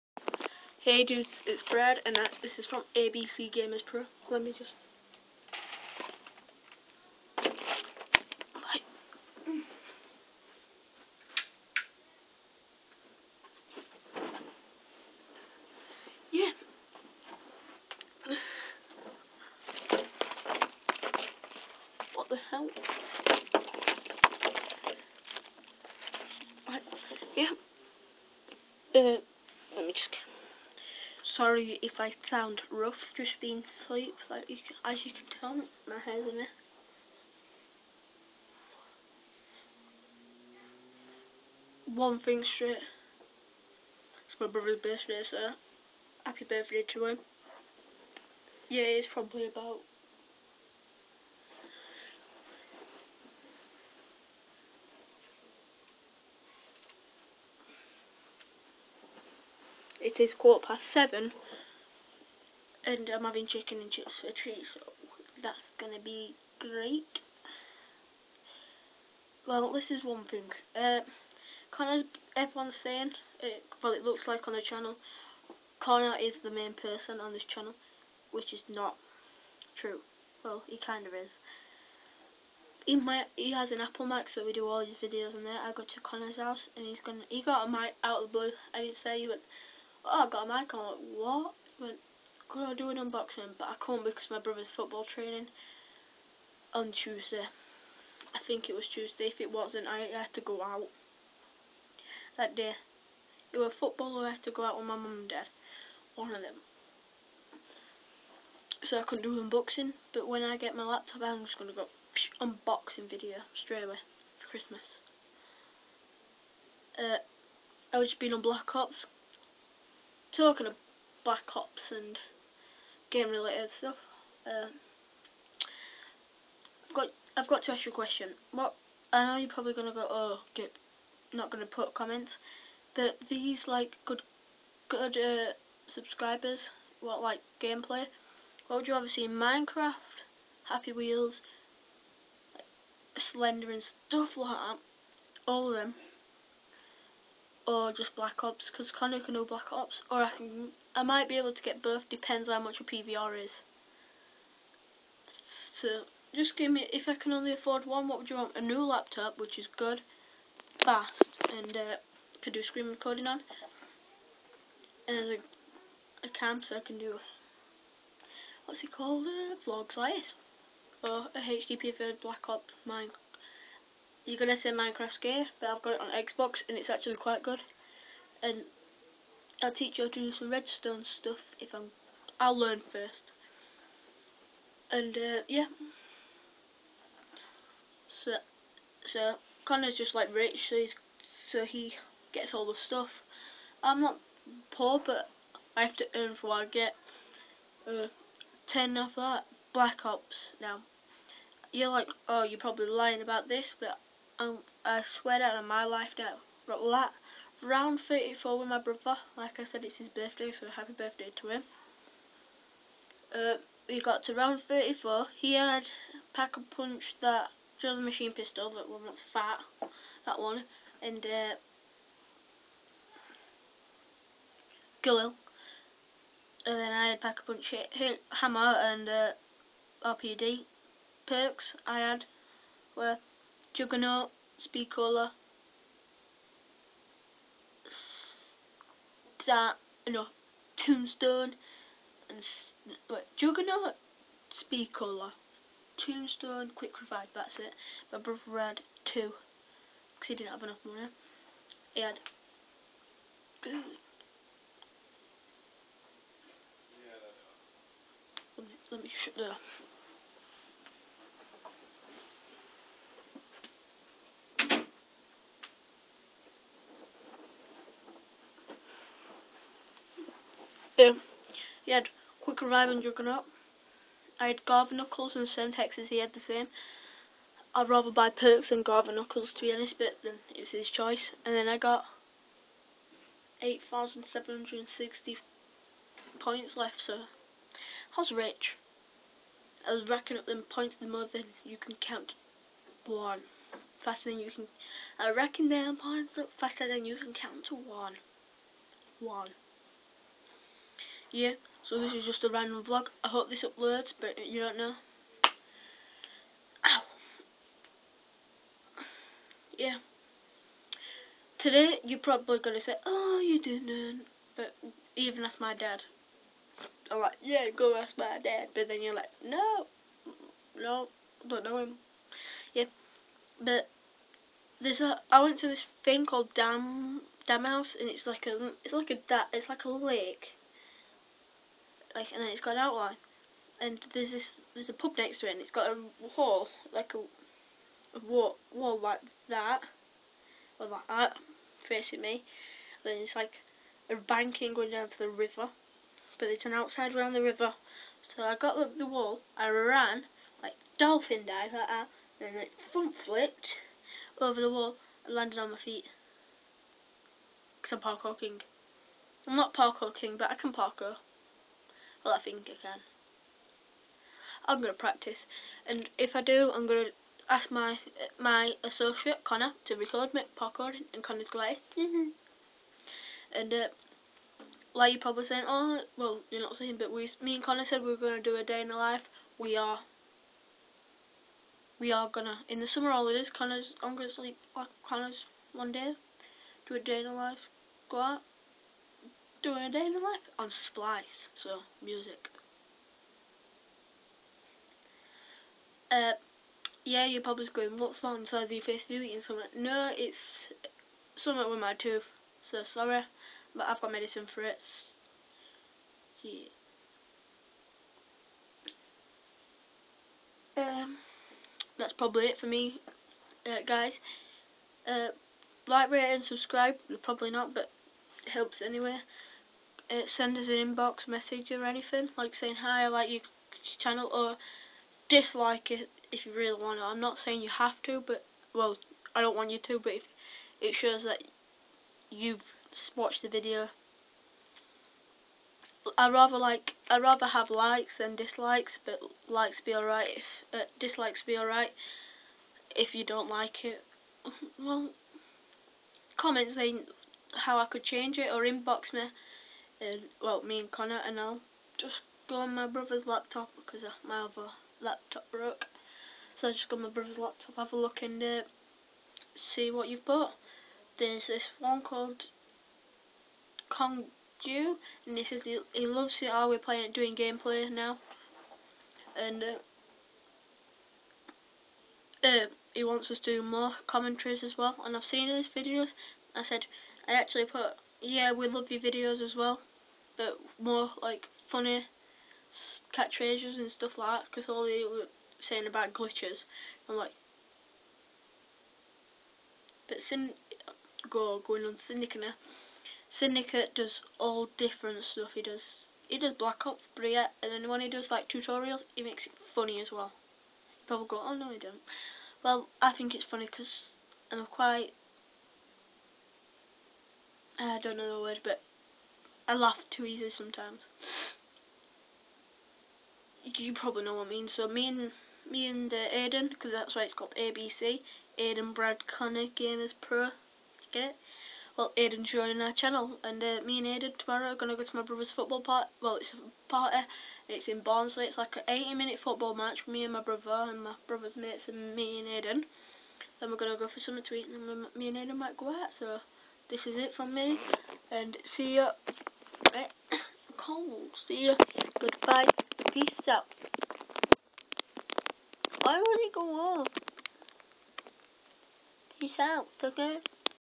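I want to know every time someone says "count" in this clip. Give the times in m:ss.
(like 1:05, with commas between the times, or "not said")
4:51, 4:57.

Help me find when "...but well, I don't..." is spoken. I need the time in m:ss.
7:08.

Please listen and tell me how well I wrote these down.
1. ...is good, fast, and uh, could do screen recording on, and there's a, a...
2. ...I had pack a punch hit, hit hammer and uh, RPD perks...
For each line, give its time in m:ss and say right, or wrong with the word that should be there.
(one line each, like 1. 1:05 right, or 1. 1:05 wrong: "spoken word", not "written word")
1. 2:39 right
2. 3:46 right.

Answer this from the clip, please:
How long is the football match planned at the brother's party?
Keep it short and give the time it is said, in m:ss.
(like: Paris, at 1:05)
80 minutes, at 8:48.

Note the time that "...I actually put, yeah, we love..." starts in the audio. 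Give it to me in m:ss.
7:57.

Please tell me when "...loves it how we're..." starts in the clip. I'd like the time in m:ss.
7:46.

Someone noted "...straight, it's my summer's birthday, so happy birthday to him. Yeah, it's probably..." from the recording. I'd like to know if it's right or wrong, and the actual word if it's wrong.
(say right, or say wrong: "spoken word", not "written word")
wrong: "brother", not "summer".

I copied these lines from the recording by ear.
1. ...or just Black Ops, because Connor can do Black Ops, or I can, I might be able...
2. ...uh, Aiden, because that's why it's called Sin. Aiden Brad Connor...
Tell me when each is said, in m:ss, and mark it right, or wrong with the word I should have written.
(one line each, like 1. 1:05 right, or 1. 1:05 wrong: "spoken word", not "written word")
1. 2:27 right
2. 8:36 wrong: "ABC", not "Sin".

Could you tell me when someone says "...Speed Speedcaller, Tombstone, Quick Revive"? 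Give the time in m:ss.
4:04.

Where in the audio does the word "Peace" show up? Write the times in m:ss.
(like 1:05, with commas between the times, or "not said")
9:03, 9:09.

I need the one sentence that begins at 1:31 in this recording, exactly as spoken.
I went, going to do an unboxing?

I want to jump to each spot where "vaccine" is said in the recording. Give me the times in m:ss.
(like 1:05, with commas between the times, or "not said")
not said.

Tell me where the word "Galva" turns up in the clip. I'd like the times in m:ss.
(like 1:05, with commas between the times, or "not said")
4:34, 4:38.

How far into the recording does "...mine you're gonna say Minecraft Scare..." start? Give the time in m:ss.
2:52.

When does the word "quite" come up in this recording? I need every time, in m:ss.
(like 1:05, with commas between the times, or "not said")
2:57, 8:24.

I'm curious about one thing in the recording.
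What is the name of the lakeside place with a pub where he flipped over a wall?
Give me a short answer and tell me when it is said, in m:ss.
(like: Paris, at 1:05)
Dam House, at 5:27.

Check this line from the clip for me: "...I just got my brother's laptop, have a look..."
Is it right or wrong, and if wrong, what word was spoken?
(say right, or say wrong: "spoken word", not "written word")
right.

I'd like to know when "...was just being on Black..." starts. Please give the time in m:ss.
1:57.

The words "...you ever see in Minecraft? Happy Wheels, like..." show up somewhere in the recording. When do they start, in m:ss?
2:18.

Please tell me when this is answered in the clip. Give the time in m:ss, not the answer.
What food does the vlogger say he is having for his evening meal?
1:03.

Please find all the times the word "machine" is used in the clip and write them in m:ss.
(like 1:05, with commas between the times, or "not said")
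3:38.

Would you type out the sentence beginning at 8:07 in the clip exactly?
I'm like, but Sin go going on Syndicate.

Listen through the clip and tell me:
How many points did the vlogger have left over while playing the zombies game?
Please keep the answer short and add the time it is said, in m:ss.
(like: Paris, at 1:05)
8,760, at 4:43.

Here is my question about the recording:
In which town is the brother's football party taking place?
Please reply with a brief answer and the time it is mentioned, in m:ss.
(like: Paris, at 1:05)
Barnsley, at 8:48.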